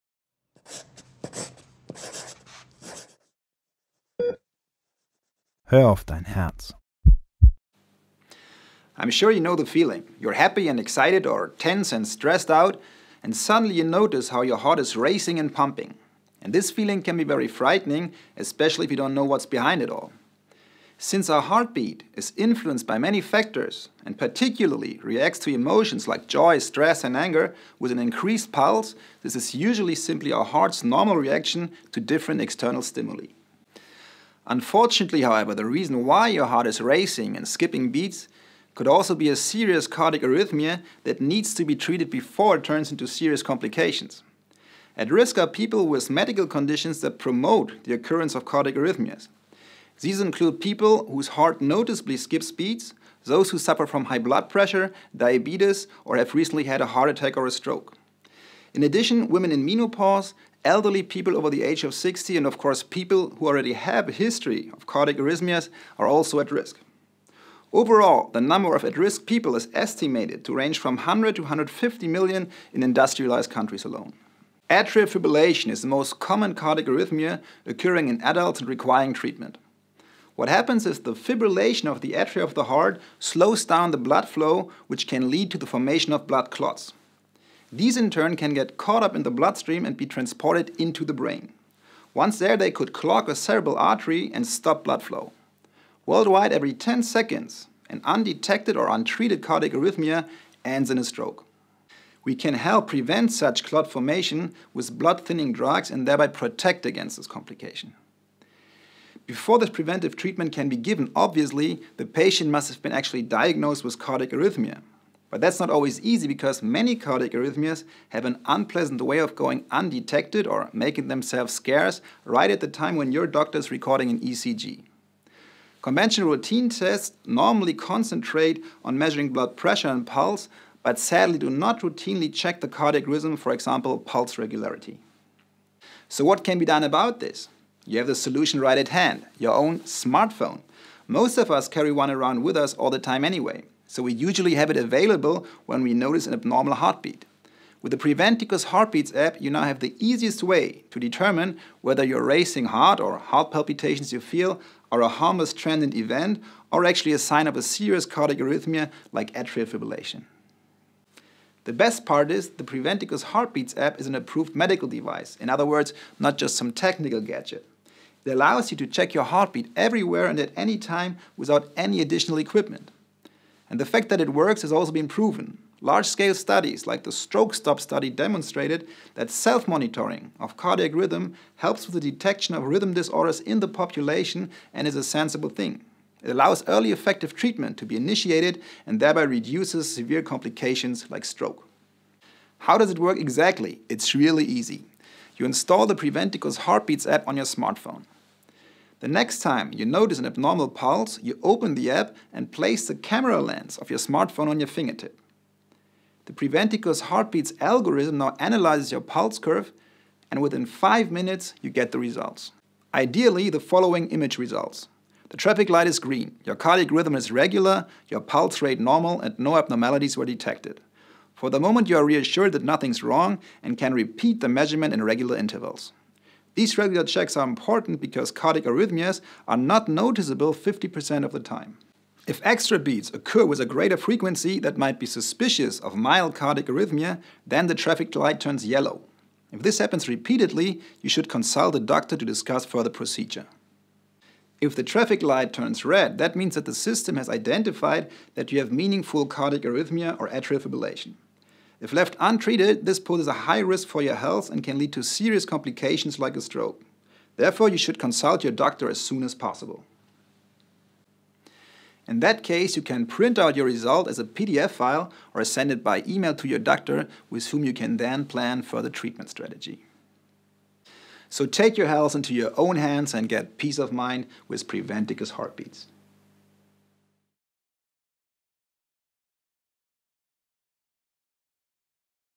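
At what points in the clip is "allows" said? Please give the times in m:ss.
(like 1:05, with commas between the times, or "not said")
2:48, 3:06.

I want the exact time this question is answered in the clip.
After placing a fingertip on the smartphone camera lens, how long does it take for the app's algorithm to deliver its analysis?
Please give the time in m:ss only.
3:30.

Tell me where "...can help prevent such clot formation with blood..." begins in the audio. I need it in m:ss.
1:42.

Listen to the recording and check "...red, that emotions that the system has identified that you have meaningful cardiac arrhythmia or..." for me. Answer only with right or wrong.
wrong.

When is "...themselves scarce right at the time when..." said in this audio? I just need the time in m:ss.
2:01.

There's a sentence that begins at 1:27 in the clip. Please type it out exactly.
These in turn can get caught up in the bloodstream and be transported into the brain.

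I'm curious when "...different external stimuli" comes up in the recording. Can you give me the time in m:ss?
0:32.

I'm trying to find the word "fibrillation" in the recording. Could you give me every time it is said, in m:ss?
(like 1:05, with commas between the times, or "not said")
1:15, 1:21, 2:39, 4:10.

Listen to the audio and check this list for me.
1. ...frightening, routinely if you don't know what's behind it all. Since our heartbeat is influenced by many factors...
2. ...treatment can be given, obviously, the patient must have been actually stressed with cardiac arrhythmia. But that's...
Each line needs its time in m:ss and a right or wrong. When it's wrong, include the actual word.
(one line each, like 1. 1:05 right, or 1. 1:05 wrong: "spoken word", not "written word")
1. 0:17 wrong: "especially", not "routinely"
2. 1:50 wrong: "diagnosed", not "stressed".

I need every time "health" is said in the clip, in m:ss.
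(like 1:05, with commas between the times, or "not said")
4:14, 4:31.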